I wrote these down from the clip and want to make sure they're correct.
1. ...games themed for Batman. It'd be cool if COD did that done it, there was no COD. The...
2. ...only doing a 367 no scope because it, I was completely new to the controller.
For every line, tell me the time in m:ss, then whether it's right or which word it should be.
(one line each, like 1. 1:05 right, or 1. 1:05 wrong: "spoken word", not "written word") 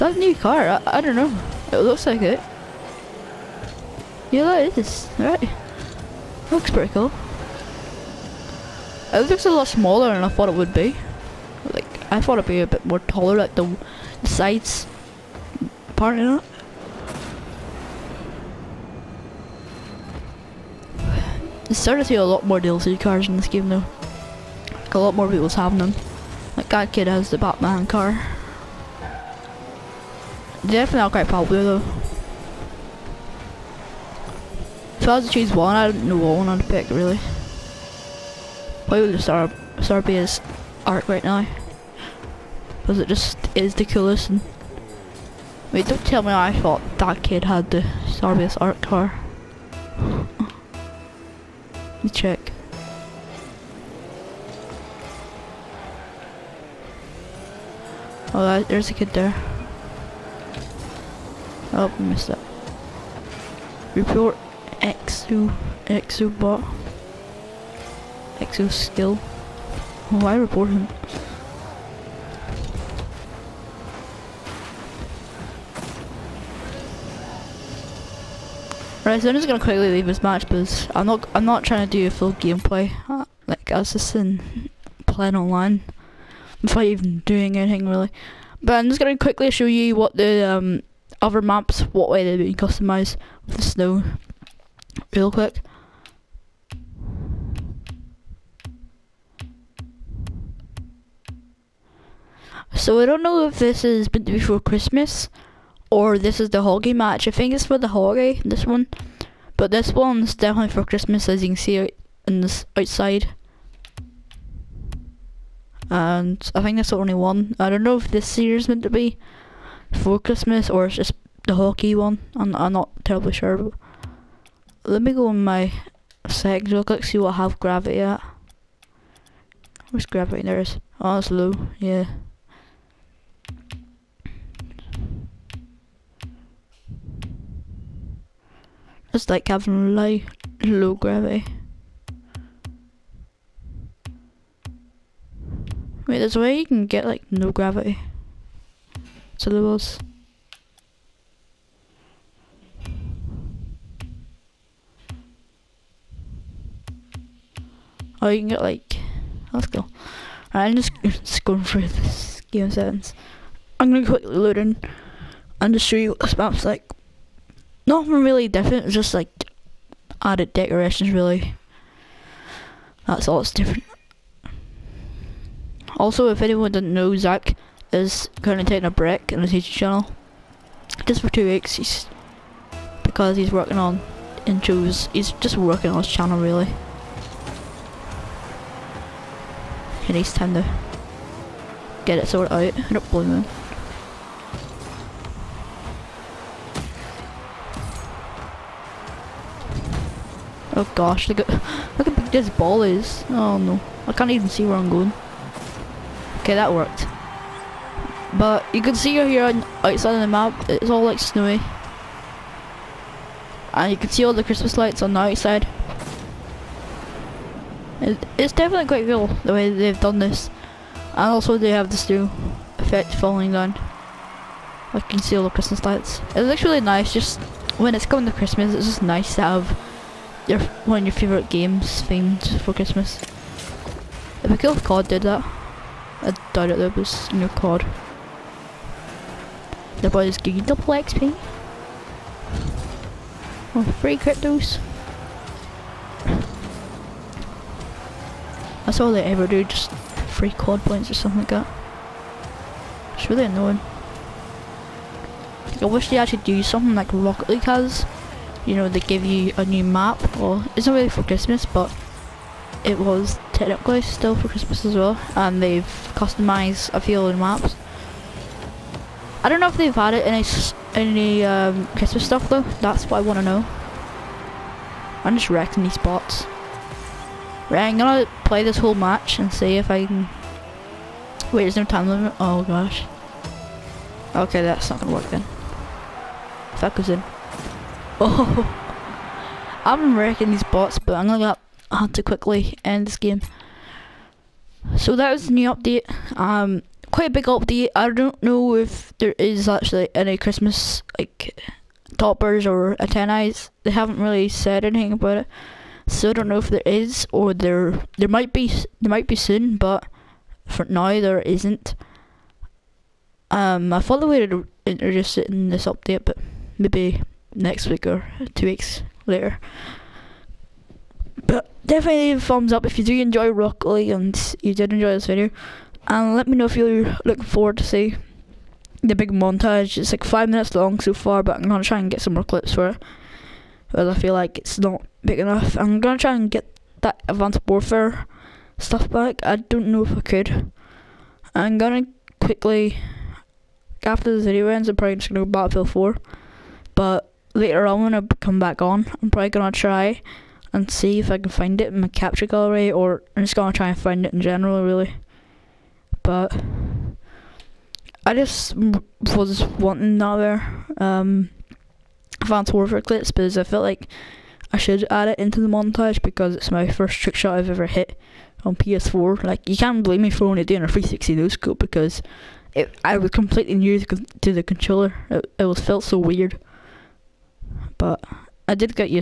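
1. 3:51 wrong: "Christmas", not "Batman"
2. 6:10 wrong: "360", not "367".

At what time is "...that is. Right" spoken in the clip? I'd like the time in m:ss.
0:04.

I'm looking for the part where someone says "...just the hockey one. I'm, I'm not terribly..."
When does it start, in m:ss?
2:00.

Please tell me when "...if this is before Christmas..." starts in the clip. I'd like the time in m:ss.
1:43.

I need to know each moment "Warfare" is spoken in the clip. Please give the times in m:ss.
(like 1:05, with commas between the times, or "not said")
5:37, 6:02.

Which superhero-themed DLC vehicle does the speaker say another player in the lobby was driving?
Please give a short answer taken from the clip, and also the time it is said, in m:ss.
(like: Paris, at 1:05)
Batman car, at 0:27.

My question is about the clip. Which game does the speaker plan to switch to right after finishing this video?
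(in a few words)
Battlefield 4.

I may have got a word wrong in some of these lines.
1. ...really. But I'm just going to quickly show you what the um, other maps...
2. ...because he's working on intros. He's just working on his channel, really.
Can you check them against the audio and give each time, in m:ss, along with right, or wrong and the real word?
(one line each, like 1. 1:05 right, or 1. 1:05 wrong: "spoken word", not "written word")
1. 1:27 right
2. 3:03 right.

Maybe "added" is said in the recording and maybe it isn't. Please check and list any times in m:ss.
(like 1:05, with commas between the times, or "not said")
2:50, 4:29.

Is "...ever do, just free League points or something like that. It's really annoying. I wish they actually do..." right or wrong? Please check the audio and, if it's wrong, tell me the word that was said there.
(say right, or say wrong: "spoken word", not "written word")
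wrong: "COD", not "League".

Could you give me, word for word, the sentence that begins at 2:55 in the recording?
Also, if anyone doesn't know, Zach is currently taking a break in his YouTube channel.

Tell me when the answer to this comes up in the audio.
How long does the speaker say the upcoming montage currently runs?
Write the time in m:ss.
5:30.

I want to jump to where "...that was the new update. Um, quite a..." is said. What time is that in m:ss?
4:55.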